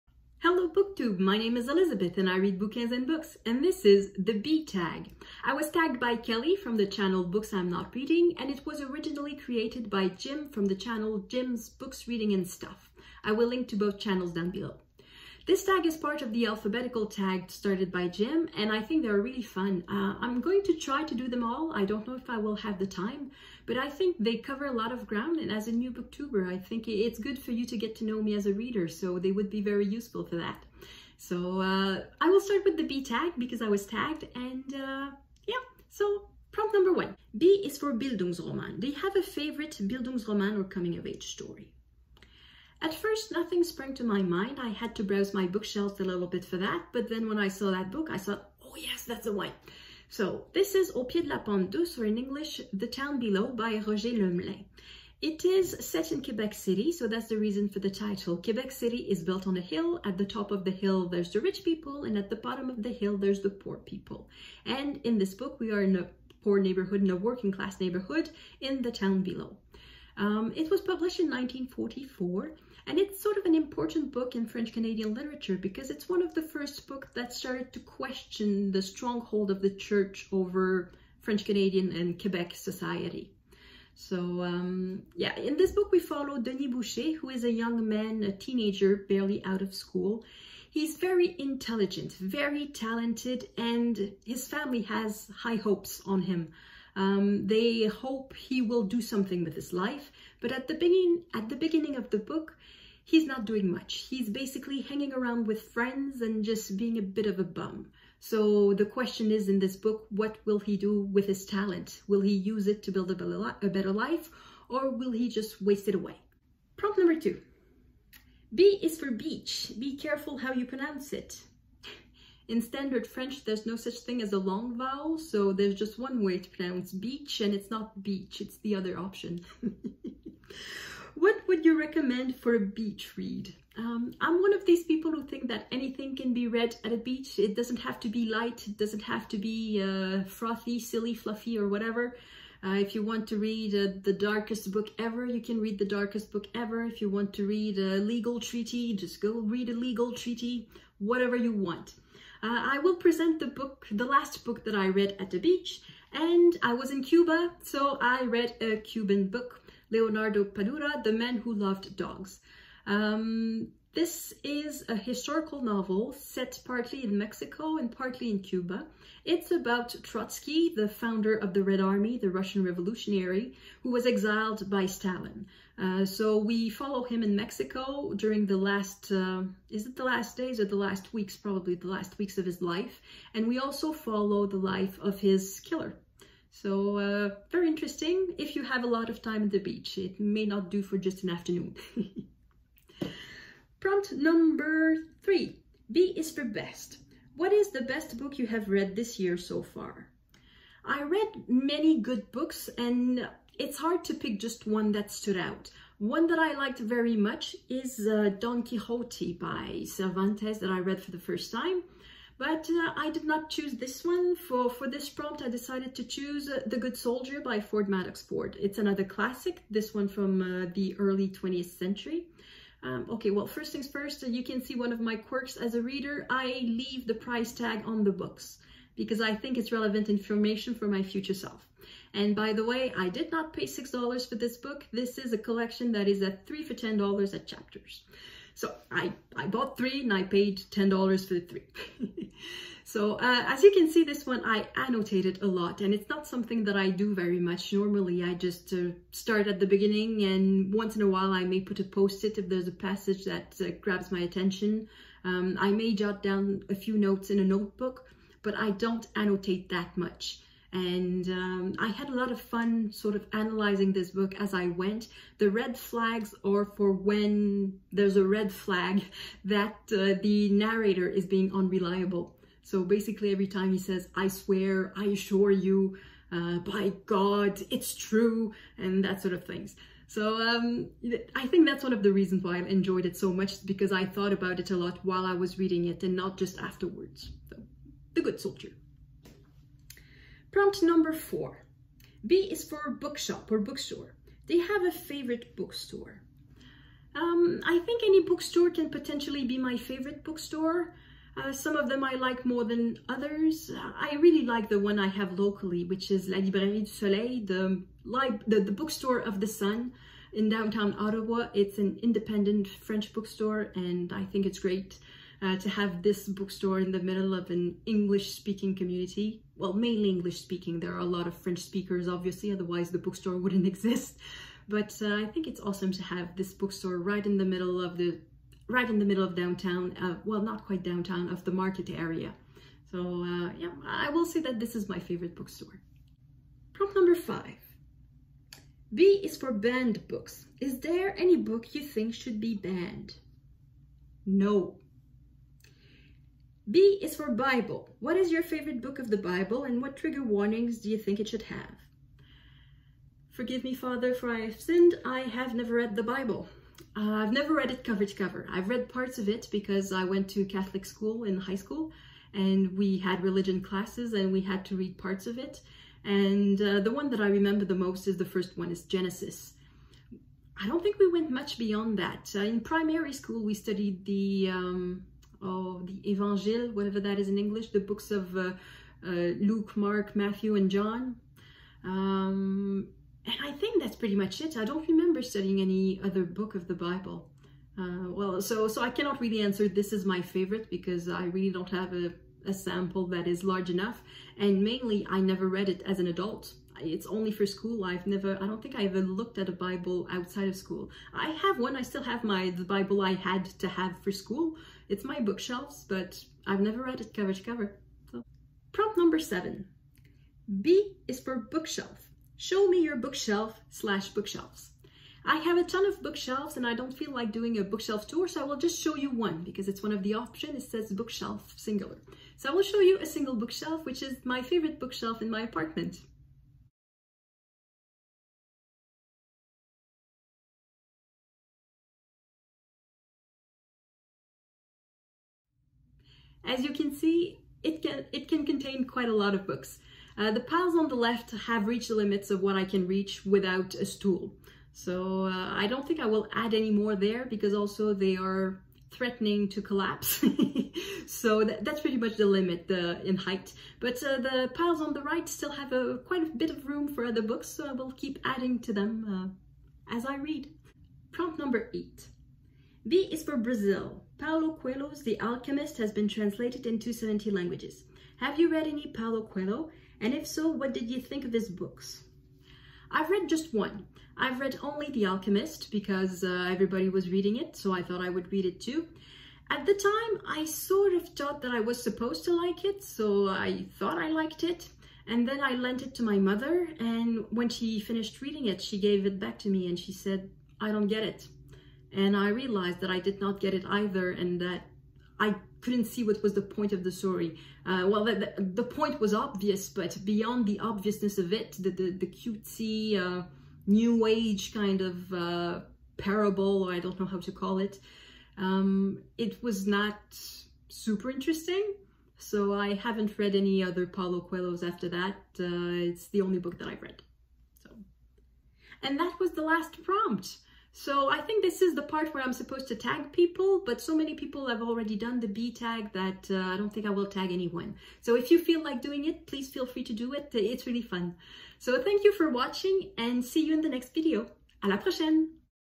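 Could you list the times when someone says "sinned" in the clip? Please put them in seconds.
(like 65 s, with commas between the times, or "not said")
354 s.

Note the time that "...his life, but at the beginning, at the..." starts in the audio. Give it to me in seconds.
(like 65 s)
99 s.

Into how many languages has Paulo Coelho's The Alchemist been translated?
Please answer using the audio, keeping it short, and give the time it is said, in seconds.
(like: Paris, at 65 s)
70, at 466 s.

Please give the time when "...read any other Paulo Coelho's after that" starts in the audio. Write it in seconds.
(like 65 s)
513 s.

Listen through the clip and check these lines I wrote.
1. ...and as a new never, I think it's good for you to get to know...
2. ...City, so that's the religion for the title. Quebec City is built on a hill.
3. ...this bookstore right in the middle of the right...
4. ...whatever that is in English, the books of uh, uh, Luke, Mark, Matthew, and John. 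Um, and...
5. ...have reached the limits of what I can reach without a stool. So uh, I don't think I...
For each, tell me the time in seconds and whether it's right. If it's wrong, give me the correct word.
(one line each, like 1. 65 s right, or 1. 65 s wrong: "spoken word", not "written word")
1. 25 s wrong: "booktuber", not "never"
2. 56 s wrong: "reason", not "religion"
3. 326 s right
4. 376 s right
5. 441 s right.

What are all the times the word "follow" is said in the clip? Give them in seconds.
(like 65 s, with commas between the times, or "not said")
85 s, 176 s, 183 s.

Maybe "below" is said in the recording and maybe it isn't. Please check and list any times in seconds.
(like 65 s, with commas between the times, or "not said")
14 s, 53 s, 69 s.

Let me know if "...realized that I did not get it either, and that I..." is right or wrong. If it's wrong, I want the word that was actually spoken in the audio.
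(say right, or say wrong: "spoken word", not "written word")
right.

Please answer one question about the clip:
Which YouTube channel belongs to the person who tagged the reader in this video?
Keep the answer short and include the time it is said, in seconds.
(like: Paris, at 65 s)
Books I'm Not Reading, at 7 s.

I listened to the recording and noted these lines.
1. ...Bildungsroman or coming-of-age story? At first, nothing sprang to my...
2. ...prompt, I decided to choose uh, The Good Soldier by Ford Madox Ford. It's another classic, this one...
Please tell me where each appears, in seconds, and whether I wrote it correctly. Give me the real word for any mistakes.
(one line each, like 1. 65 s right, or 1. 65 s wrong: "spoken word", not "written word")
1. 39 s right
2. 215 s right.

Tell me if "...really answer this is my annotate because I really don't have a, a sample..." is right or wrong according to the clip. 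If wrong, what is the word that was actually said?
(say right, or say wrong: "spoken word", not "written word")
wrong: "favorite", not "annotate".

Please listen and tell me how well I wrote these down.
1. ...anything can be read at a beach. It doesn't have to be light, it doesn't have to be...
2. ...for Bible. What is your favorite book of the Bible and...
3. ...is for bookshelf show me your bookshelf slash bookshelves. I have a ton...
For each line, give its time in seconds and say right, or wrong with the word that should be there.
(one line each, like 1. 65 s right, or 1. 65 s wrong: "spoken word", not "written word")
1. 135 s right
2. 347 s right
3. 411 s right.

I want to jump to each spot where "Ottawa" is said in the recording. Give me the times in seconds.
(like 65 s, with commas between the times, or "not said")
310 s.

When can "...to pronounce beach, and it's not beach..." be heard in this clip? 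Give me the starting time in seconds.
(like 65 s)
126 s.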